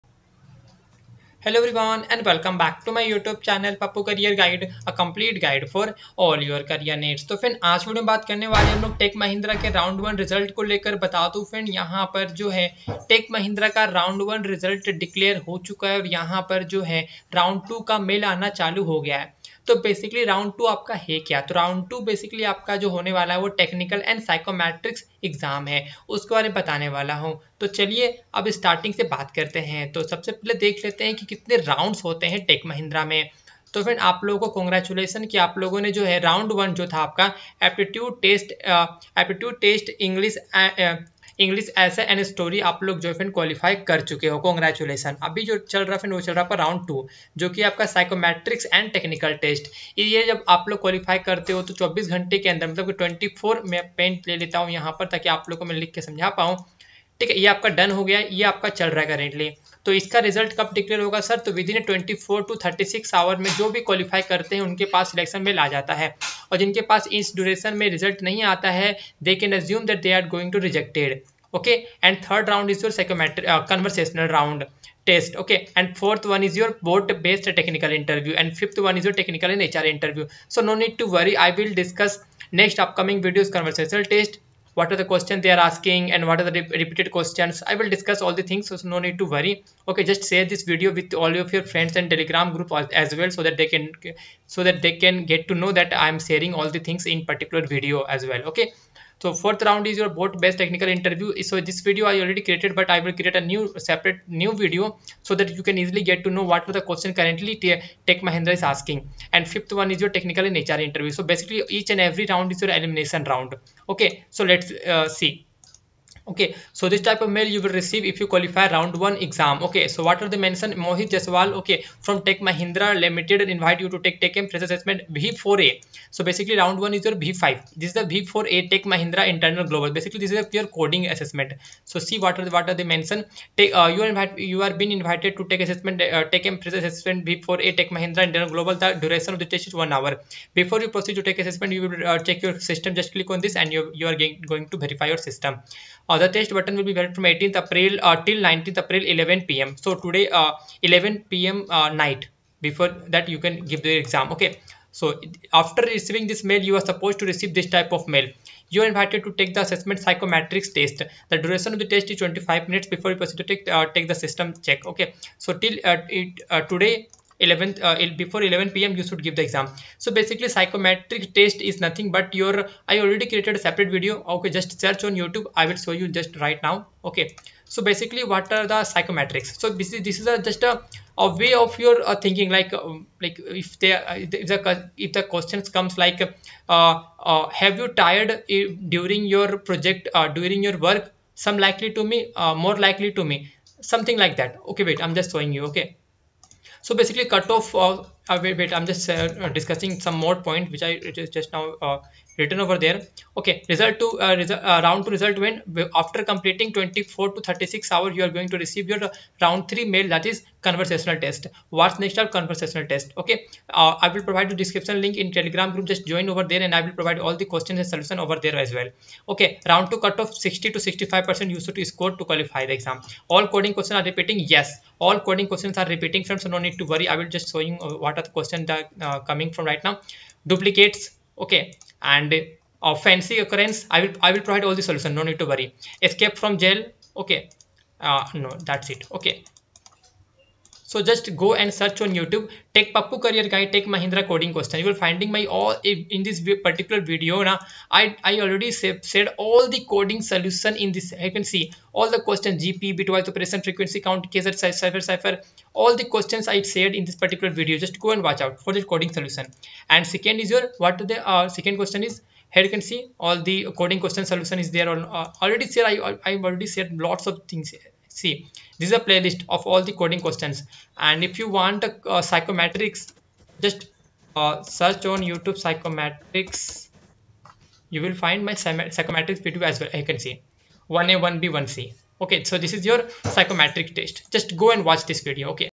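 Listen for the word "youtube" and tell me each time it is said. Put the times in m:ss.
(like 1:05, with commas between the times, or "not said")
2:55, 4:02, 4:35.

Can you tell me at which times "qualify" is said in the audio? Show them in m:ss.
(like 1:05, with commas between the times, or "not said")
1:58, 3:42.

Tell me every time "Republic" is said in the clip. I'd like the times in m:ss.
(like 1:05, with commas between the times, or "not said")
not said.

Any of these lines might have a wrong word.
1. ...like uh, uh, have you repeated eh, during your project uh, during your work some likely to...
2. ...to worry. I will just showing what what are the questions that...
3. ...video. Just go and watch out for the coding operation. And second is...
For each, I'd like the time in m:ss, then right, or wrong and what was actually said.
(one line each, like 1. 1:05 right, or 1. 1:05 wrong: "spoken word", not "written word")
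1. 3:06 wrong: "tired", not "repeated"
2. 3:46 right
3. 4:17 wrong: "solution", not "operation".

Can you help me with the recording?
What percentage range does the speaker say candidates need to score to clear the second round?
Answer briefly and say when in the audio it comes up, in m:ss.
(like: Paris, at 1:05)
60 to 65 percent, at 3:40.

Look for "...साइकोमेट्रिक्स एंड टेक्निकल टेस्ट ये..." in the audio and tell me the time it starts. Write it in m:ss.
0:47.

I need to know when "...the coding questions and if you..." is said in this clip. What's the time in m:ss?
4:29.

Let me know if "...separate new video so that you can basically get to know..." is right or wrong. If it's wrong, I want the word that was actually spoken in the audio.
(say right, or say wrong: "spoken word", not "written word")
wrong: "easily", not "basically".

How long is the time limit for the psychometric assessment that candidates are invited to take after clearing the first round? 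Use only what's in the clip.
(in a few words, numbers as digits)
25 minutes.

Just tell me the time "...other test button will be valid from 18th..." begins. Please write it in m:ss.
2:26.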